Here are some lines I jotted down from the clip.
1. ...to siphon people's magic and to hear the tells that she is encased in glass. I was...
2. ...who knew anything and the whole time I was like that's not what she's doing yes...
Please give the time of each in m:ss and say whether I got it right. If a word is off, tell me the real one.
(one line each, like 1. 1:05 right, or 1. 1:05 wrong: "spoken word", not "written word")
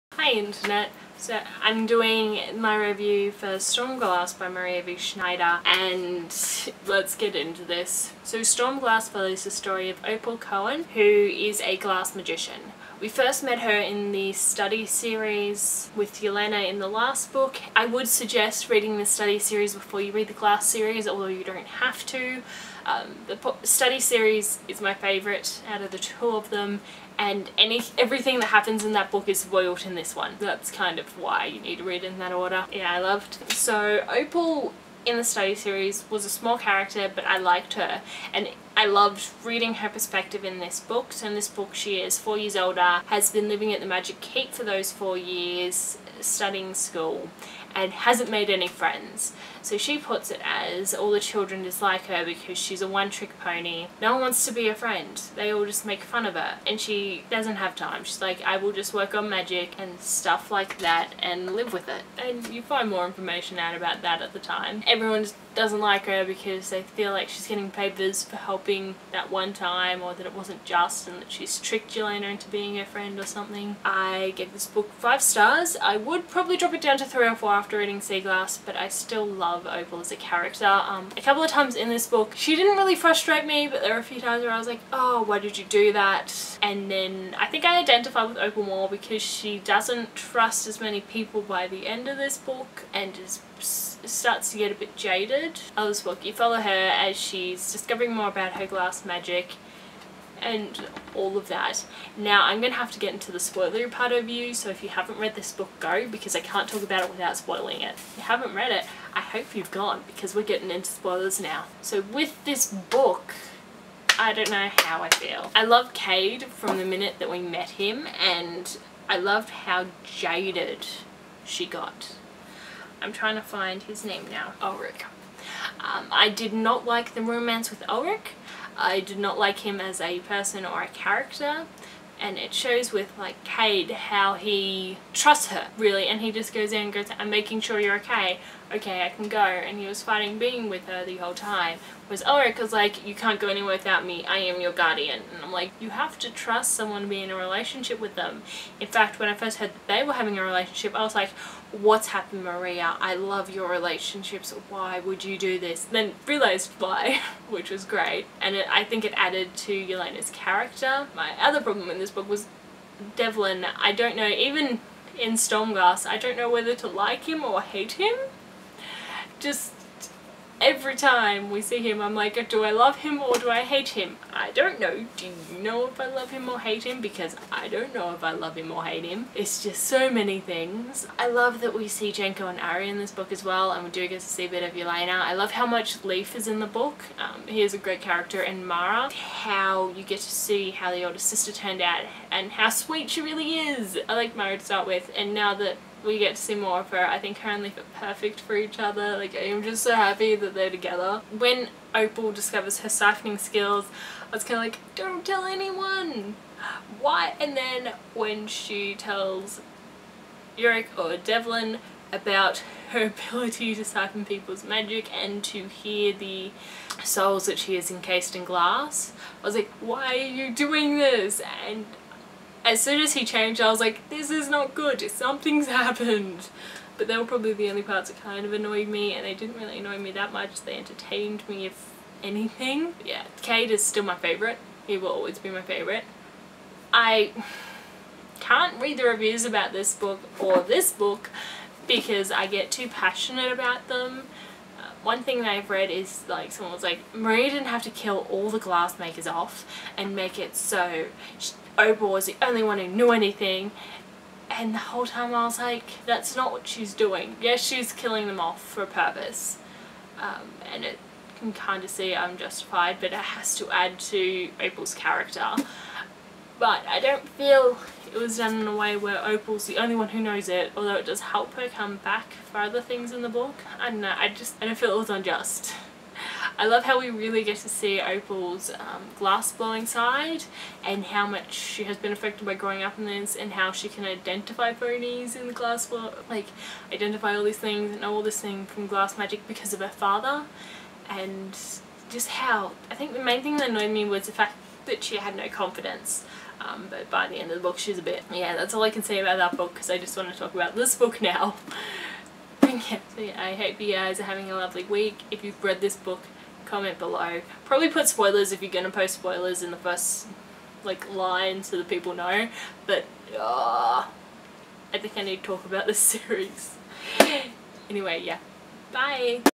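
1. 3:33 wrong: "souls", not "tells"
2. 4:12 right.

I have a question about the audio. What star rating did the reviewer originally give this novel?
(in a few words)
5 stars.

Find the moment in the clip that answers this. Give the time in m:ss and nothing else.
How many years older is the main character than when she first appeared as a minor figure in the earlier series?
0:42.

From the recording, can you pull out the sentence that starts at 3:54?
He will always be my favourite.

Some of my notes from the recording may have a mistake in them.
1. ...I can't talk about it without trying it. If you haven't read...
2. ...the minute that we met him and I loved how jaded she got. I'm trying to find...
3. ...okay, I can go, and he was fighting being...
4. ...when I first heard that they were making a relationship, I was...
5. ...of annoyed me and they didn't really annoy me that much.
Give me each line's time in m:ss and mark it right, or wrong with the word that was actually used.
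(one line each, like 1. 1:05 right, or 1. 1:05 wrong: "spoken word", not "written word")
1. 1:46 wrong: "spoiling", not "trying"
2. 1:56 right
3. 2:18 right
4. 2:29 wrong: "having", not "making"
5. 3:48 right.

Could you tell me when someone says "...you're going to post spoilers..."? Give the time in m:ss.
5:08.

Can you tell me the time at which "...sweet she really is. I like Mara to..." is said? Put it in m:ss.
3:12.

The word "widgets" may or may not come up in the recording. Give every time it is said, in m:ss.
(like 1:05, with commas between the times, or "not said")
not said.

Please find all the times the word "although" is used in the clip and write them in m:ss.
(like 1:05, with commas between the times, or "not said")
0:21, 4:30.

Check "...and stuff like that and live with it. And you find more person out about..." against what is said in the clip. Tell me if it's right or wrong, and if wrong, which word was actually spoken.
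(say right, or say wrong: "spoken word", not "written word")
wrong: "information", not "person".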